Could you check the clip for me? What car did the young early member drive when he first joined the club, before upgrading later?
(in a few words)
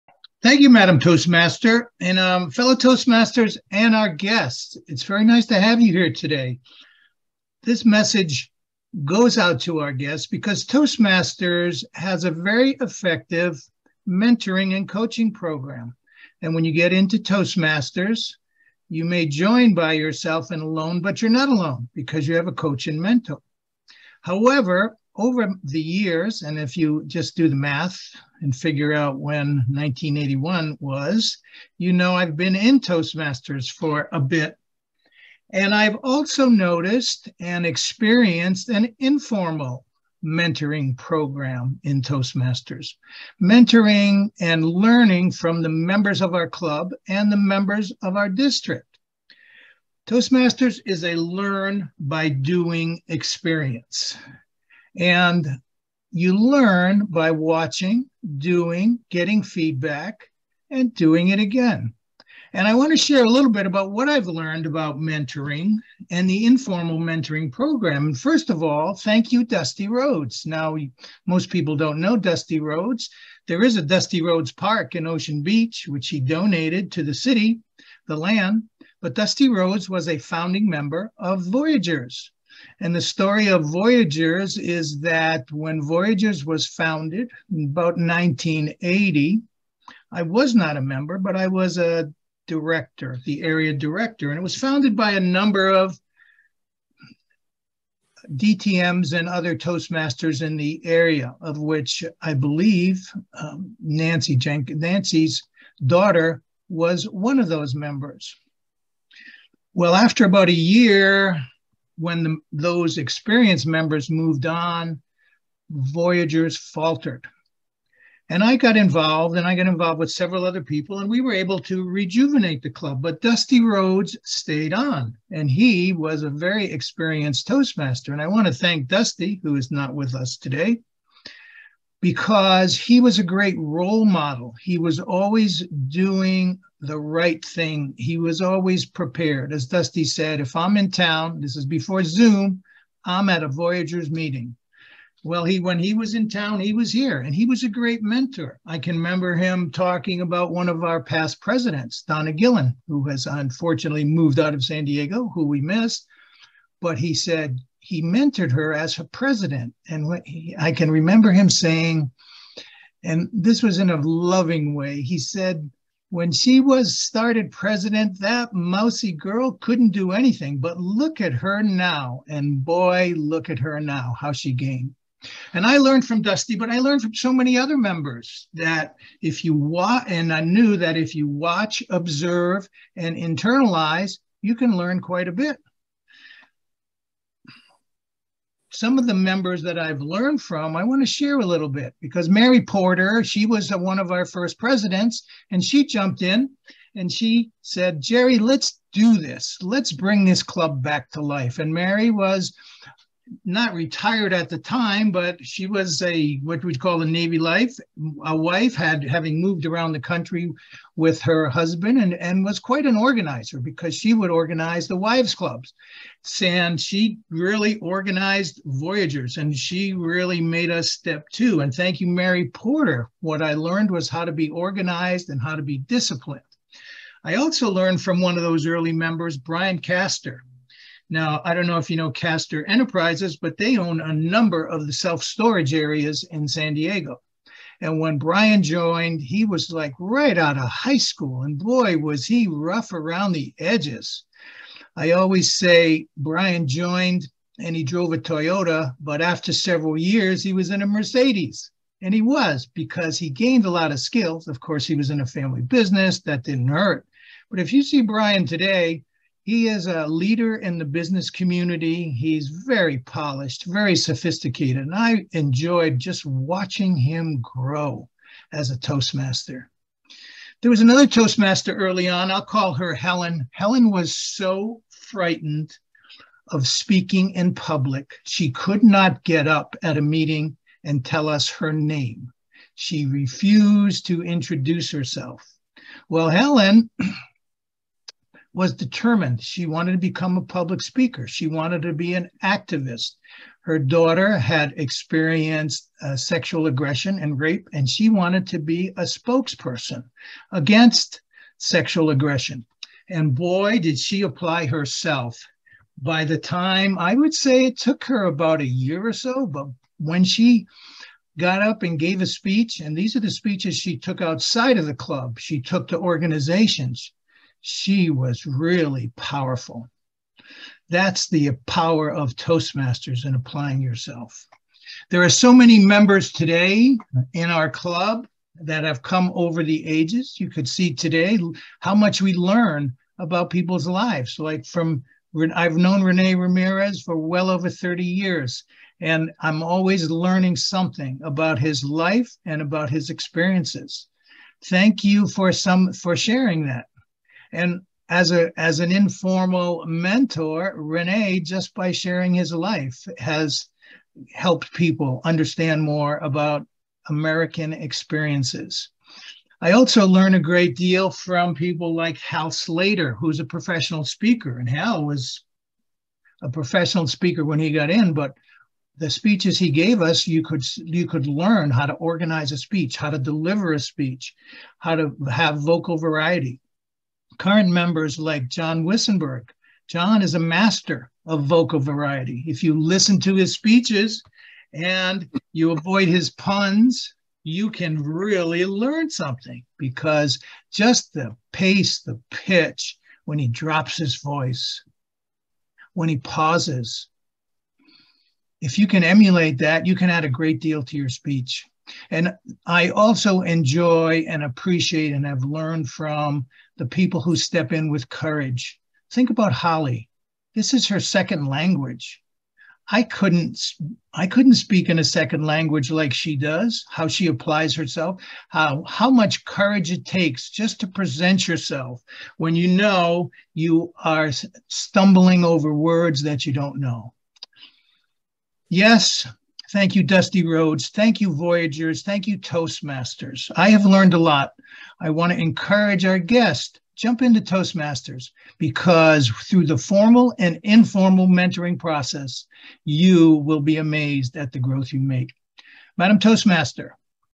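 Toyota.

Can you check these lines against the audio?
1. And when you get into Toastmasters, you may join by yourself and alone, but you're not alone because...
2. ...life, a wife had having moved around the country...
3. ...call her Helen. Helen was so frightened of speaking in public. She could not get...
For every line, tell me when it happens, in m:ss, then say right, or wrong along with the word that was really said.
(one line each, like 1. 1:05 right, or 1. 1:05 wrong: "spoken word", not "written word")
1. 0:16 right
2. 3:27 right
3. 4:32 right.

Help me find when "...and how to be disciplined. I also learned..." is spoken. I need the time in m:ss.
3:45.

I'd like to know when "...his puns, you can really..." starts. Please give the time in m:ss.
6:26.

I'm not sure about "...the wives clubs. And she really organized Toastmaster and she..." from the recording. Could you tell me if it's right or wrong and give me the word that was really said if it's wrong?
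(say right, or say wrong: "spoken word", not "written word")
wrong: "Voyagers", not "Toastmaster".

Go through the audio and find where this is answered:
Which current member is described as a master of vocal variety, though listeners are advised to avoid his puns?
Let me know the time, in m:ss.
6:18.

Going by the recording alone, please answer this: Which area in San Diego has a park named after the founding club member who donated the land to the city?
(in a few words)
Ocean Beach.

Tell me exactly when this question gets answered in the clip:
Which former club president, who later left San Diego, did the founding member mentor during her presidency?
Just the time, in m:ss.
2:32.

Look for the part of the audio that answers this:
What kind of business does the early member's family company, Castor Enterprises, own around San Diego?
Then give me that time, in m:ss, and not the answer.
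3:54.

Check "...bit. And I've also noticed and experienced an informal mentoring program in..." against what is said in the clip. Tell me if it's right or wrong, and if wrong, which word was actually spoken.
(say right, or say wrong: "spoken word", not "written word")
right.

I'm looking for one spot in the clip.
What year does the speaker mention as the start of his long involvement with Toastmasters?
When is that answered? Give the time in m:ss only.
0:29.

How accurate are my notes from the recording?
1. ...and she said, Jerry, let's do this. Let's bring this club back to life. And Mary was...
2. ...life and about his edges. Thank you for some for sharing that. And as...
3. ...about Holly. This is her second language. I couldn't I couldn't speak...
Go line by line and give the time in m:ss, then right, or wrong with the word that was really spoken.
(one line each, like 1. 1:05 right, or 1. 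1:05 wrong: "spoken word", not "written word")
1. 3:16 right
2. 5:41 wrong: "experiences", not "edges"
3. 6:49 right.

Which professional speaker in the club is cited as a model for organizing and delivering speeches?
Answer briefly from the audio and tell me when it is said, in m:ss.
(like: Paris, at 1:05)
Hal Slater, at 6:02.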